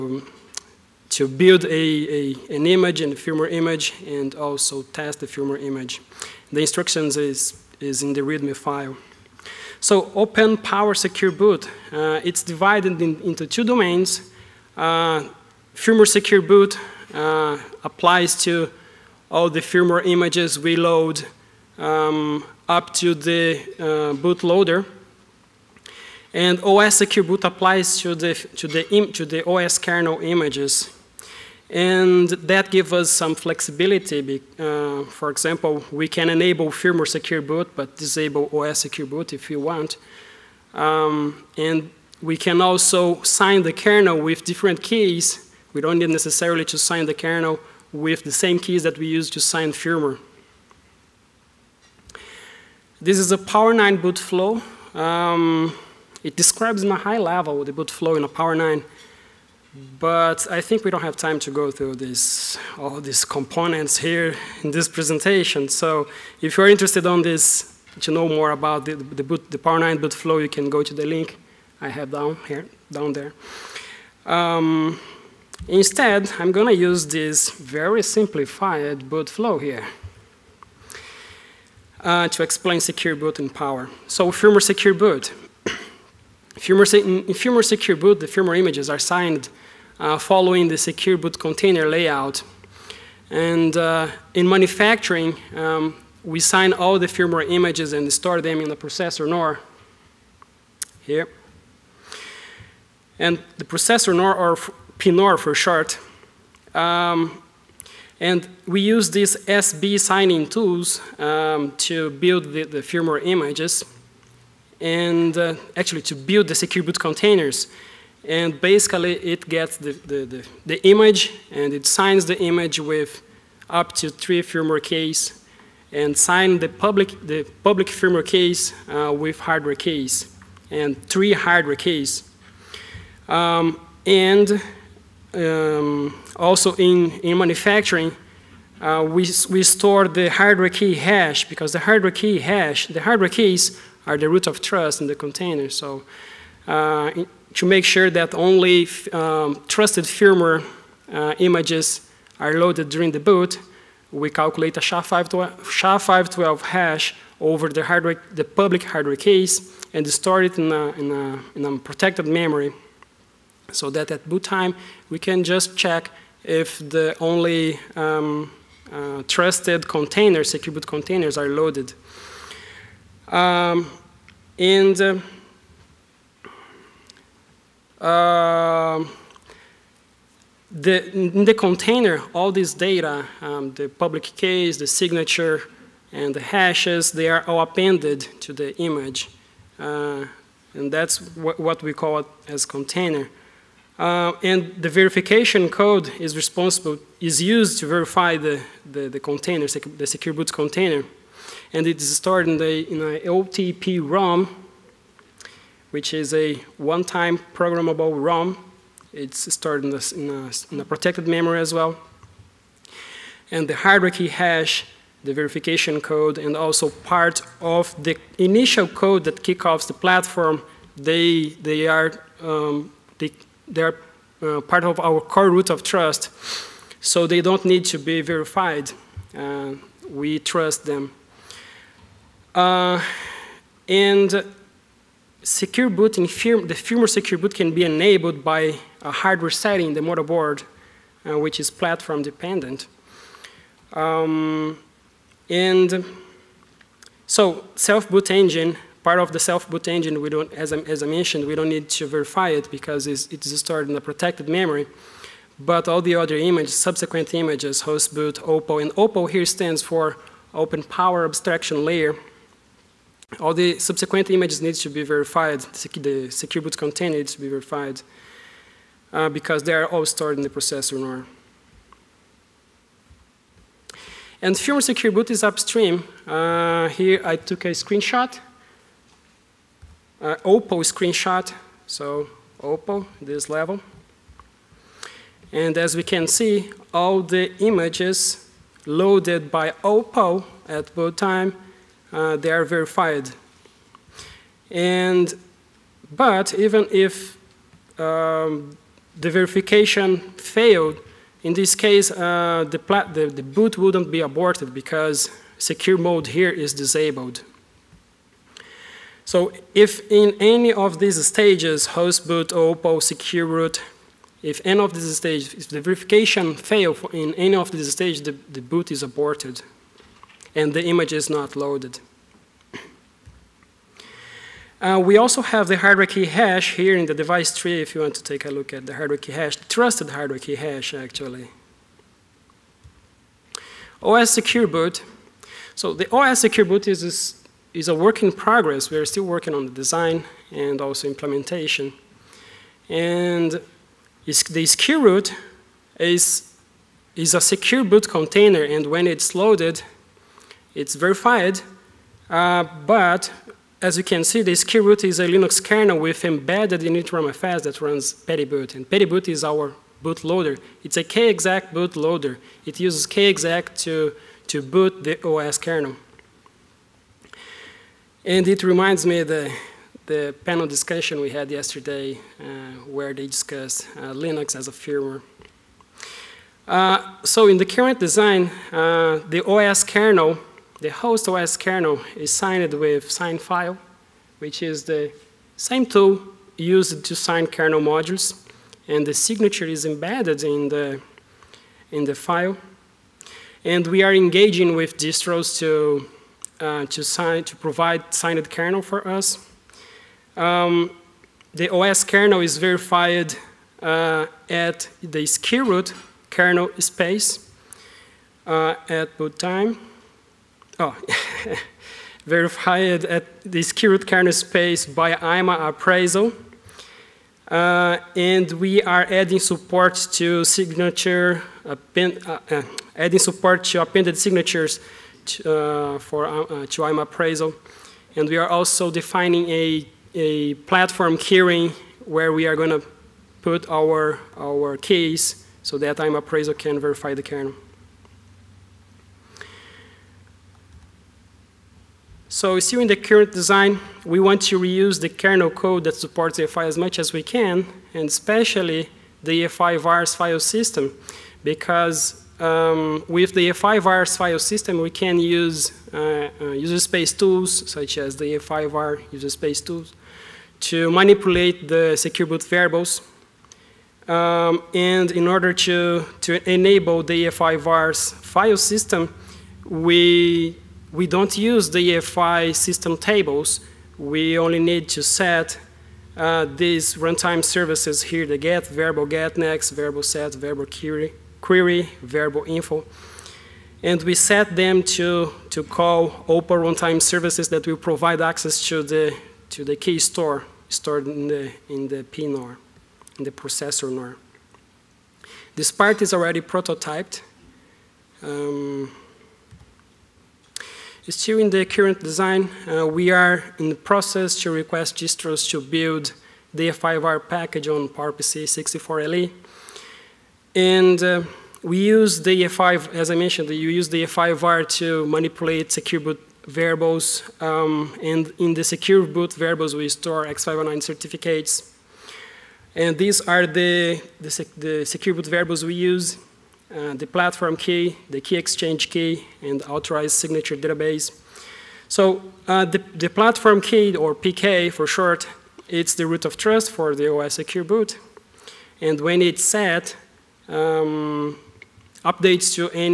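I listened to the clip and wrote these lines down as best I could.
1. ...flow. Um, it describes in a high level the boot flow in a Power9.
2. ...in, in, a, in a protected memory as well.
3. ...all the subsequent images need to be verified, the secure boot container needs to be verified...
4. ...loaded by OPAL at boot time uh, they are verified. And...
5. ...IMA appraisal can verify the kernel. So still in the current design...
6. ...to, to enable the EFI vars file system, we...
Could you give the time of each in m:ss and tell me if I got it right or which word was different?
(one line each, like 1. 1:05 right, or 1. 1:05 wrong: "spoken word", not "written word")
1. 0:54 right
2. 3:29 right
3. 4:23 right
4. 4:48 right
5. 7:15 right
6. 7:45 right.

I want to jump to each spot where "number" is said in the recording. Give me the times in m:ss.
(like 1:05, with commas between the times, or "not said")
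not said.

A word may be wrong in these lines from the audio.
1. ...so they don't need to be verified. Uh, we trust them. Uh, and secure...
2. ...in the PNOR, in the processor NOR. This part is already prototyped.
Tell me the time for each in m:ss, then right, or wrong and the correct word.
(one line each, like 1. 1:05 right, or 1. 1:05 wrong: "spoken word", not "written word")
1. 3:46 right
2. 8:11 right.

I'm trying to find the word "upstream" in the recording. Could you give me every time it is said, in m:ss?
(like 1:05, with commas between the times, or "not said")
4:35.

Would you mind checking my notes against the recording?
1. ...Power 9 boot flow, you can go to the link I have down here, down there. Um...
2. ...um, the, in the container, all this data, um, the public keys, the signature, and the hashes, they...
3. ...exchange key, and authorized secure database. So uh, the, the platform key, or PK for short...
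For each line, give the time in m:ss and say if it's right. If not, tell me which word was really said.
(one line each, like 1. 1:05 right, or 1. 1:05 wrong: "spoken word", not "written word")
1. 1:09 right
2. 2:58 right
3. 8:48 wrong: "signature", not "secure".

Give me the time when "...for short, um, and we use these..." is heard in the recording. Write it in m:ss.
1:45.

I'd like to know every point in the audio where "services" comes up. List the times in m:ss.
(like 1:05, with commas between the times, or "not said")
7:57, 8:07.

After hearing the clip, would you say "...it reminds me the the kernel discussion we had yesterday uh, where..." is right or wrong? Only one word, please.
wrong.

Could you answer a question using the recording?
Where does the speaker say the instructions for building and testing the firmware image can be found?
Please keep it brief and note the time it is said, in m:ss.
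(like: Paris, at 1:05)
README file, at 0:08.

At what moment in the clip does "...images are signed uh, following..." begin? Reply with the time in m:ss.
1:28.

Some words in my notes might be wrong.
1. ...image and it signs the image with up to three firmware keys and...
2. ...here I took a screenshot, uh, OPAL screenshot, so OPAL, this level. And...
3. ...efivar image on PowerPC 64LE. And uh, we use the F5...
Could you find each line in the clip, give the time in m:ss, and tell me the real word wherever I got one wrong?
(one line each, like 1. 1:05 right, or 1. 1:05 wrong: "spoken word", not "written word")
1. 2:00 right
2. 4:36 right
3. 8:26 wrong: "package", not "image".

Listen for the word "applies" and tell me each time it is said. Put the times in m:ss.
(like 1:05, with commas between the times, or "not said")
0:17, 0:27.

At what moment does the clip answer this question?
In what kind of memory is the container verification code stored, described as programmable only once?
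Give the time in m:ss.
3:23.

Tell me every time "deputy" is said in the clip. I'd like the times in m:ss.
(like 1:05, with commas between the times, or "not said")
not said.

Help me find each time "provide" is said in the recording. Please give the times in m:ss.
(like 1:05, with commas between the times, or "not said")
6:37, 8:07.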